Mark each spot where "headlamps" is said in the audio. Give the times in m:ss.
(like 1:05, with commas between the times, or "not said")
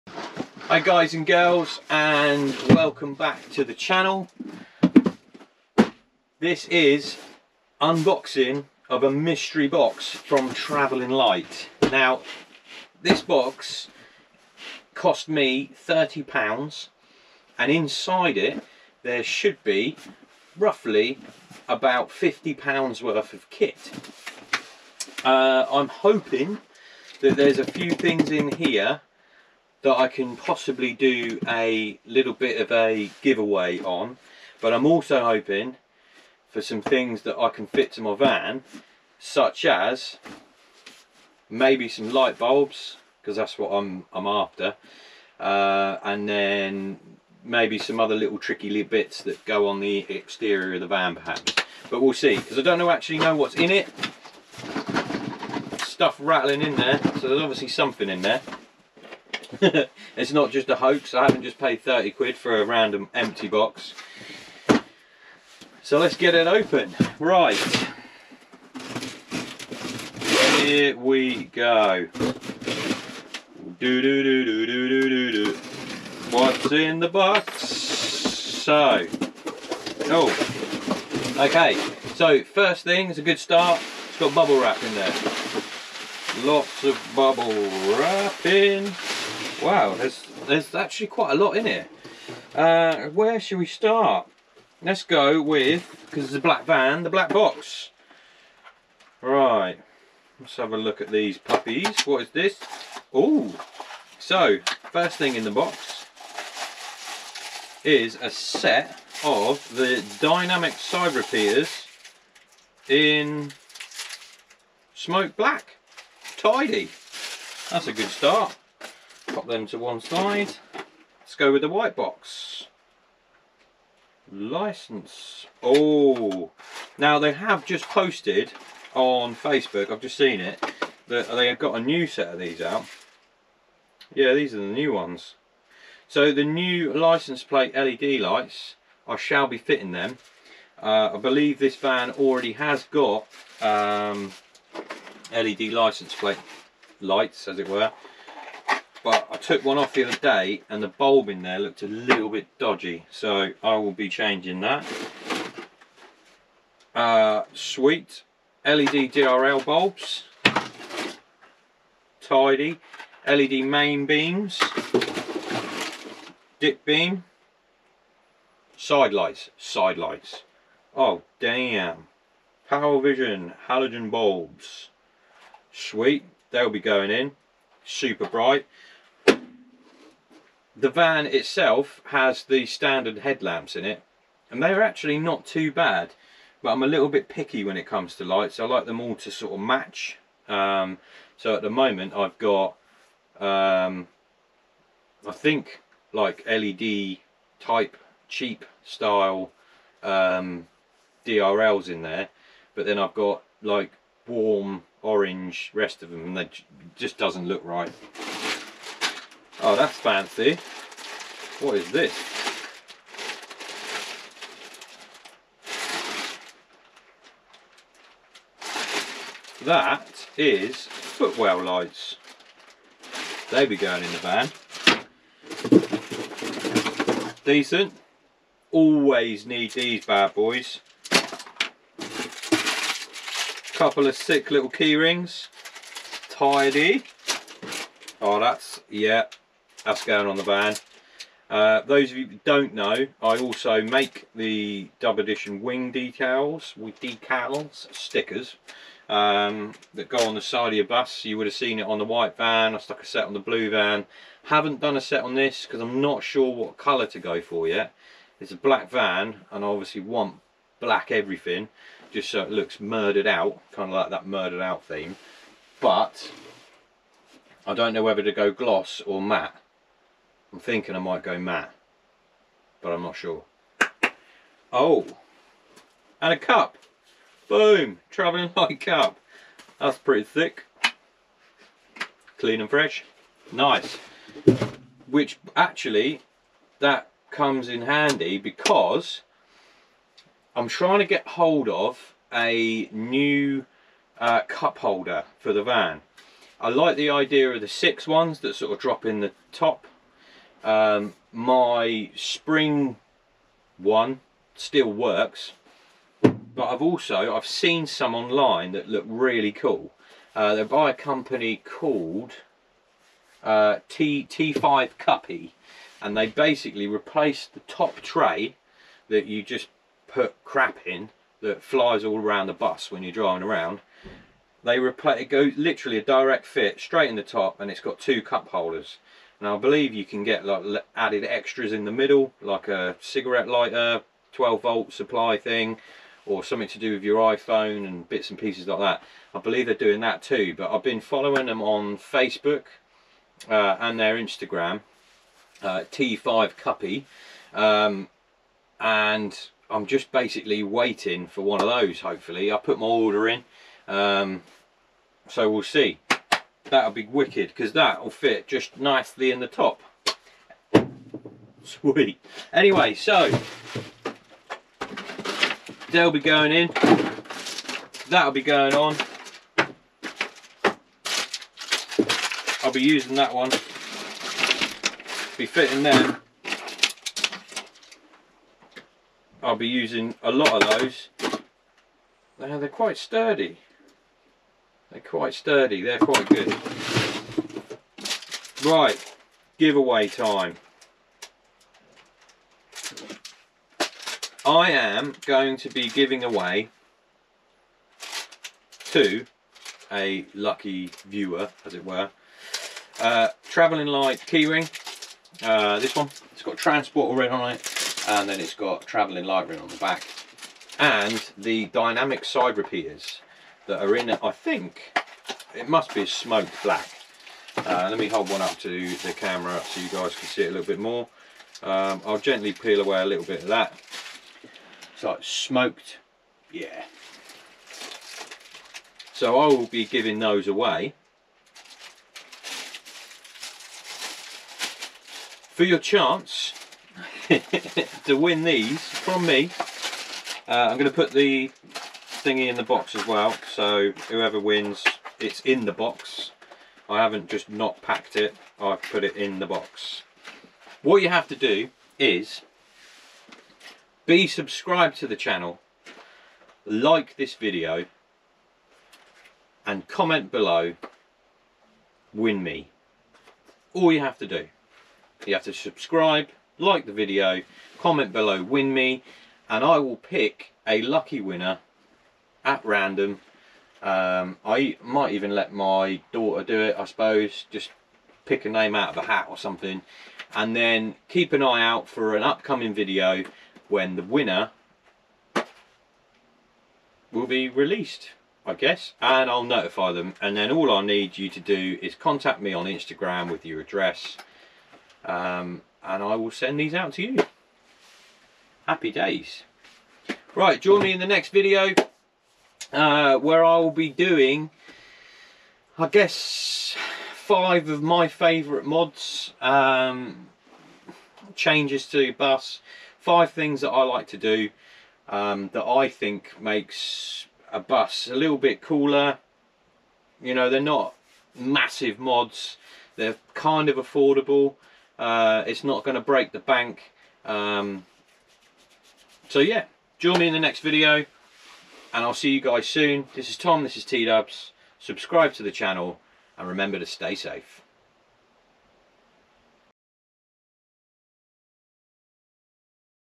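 3:03.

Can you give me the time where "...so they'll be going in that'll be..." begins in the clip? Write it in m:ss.
6:02.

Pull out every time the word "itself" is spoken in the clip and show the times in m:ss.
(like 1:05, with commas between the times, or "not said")
3:01.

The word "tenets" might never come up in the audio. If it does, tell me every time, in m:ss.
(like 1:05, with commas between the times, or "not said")
not said.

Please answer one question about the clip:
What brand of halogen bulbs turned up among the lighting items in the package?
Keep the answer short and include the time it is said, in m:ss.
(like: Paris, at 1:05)
Power Vision, at 2:52.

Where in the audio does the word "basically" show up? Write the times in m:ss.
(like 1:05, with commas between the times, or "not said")
5:16, 5:50.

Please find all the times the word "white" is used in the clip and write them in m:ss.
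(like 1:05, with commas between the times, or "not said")
2:01, 4:12.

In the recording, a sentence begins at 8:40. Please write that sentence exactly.
You know, they're not massive mods.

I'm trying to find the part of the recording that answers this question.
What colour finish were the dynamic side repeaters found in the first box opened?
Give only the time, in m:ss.
1:54.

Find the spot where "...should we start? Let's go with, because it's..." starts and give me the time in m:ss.
1:33.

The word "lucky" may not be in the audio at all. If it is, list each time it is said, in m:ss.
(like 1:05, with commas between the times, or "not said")
6:40, 7:50.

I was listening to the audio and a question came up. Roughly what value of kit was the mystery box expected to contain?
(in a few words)
£50.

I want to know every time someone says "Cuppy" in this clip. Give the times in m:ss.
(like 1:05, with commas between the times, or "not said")
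5:14, 5:46.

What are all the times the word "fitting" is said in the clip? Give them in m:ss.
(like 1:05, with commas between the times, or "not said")
2:19, 6:15.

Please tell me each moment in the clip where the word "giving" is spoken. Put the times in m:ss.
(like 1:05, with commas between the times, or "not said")
6:35, 7:09.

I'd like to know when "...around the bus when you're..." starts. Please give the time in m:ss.
5:22.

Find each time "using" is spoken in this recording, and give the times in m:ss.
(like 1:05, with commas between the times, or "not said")
6:12, 6:19.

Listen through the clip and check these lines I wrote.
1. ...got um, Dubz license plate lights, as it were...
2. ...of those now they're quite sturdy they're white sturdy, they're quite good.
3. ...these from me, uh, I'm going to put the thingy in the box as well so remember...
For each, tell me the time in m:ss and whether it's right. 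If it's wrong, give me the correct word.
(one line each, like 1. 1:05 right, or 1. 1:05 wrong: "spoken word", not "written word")
1. 2:22 wrong: "LED", not "Dubz"
2. 6:20 wrong: "quite", not "white"
3. 7:18 wrong: "whoever", not "remember".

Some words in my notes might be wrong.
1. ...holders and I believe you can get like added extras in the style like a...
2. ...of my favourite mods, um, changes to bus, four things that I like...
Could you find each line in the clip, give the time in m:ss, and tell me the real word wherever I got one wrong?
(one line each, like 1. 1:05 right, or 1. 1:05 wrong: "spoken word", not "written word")
1. 5:28 wrong: "middle", not "style"
2. 8:27 wrong: "five", not "four".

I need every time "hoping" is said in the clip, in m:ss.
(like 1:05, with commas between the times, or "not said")
0:25, 0:35.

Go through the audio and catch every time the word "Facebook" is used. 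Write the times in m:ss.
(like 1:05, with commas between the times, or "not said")
2:09, 5:41.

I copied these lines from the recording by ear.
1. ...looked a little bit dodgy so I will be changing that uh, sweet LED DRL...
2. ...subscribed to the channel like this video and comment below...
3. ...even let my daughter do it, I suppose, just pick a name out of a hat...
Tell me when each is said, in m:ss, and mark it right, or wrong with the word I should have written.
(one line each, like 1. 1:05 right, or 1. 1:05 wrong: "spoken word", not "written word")
1. 2:31 right
2. 7:34 right
3. 7:55 right.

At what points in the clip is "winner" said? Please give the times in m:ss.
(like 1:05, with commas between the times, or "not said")
7:51, 8:04.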